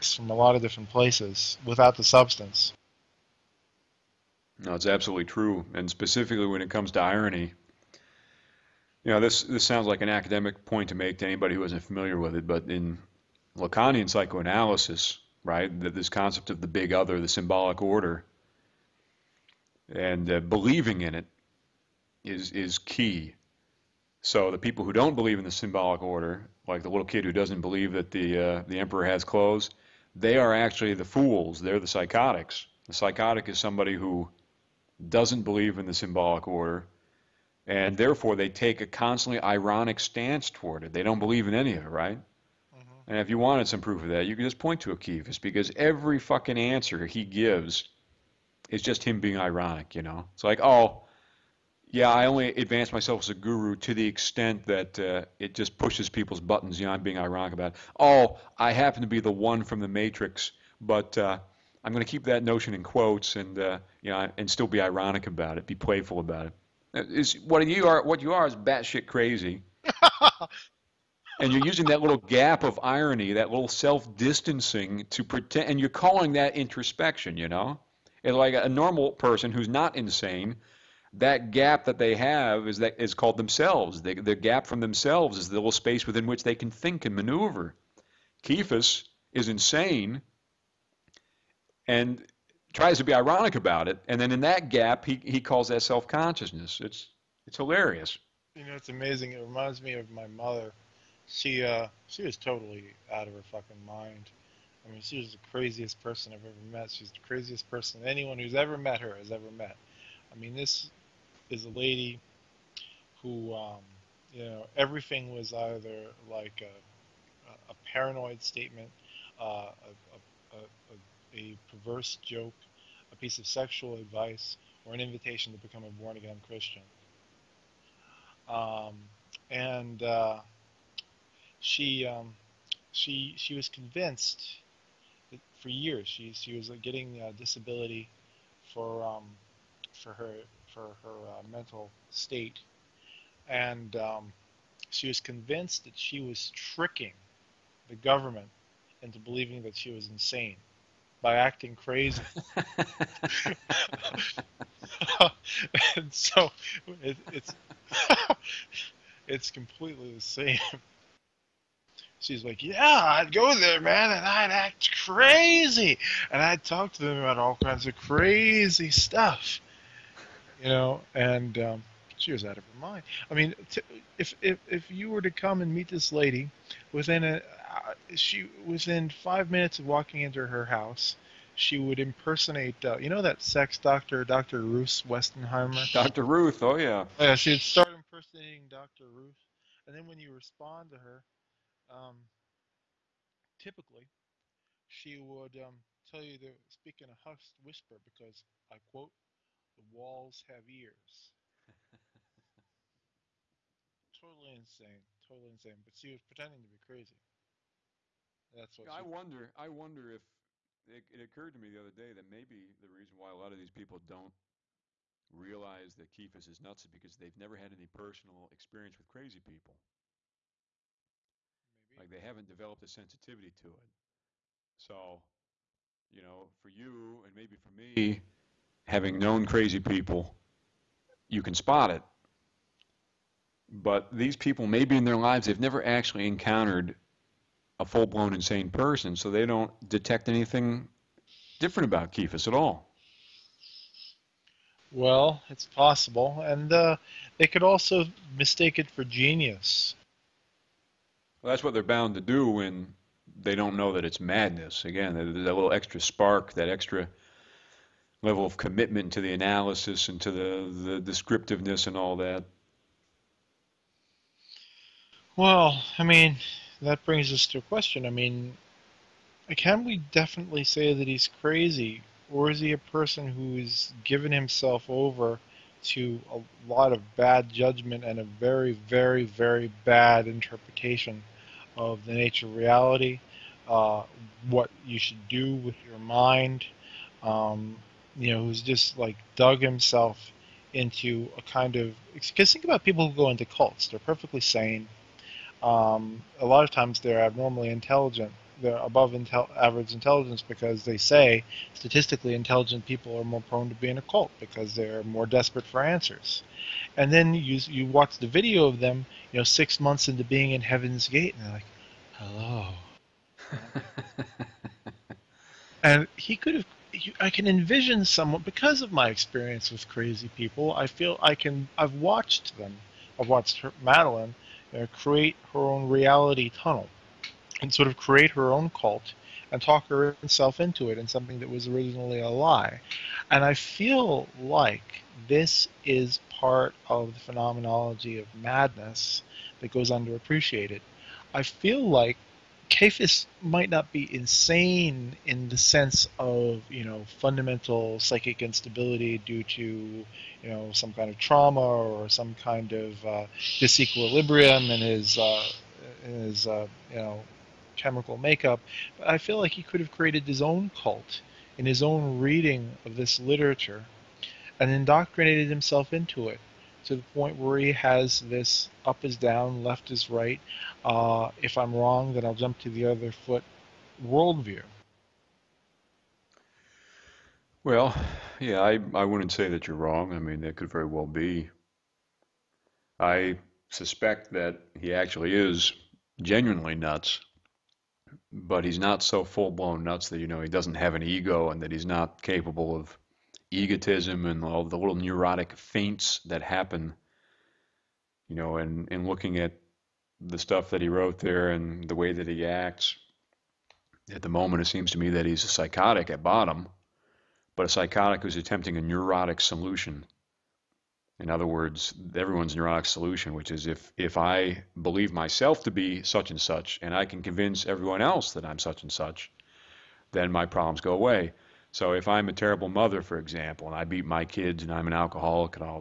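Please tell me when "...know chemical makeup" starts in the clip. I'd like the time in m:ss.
5:56.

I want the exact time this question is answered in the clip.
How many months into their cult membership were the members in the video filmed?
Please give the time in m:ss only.
5:09.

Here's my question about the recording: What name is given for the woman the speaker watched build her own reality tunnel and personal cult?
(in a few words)
Madeline.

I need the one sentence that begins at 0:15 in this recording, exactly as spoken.
This concept of the big other, the symbolic order, and uh, believing in it is is key.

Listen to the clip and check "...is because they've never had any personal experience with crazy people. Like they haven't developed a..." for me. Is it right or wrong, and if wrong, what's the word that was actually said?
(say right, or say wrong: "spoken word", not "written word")
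right.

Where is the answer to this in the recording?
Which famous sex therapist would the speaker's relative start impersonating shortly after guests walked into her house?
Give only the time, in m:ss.
3:04.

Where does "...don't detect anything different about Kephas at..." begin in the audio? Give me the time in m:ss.
3:59.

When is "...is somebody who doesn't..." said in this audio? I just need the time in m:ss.
0:33.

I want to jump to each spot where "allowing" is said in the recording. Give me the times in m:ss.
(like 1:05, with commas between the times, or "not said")
not said.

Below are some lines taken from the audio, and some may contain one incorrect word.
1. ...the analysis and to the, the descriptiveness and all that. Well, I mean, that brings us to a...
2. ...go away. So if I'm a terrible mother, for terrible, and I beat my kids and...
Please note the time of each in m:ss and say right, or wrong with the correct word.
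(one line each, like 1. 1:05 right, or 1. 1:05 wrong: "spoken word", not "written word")
1. 4:19 right
2. 7:00 wrong: "example", not "terrible".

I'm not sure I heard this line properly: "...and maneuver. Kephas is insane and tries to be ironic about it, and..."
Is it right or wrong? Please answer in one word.
right.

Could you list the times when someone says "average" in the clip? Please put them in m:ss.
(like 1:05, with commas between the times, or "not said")
4:59.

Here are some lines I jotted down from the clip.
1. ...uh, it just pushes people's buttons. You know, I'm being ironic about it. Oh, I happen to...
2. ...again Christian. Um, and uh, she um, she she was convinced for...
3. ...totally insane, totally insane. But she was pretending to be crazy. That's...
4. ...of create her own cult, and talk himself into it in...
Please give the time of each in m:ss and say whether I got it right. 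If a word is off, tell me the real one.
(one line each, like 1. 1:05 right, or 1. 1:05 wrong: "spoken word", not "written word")
1. 0:55 right
2. 2:06 right
3. 3:24 right
4. 5:27 wrong: "herself", not "himself".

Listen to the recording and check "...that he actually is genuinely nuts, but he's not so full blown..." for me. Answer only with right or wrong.
right.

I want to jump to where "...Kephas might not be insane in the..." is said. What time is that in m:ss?
5:42.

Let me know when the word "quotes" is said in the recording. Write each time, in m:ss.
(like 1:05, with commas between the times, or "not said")
1:02, 3:18.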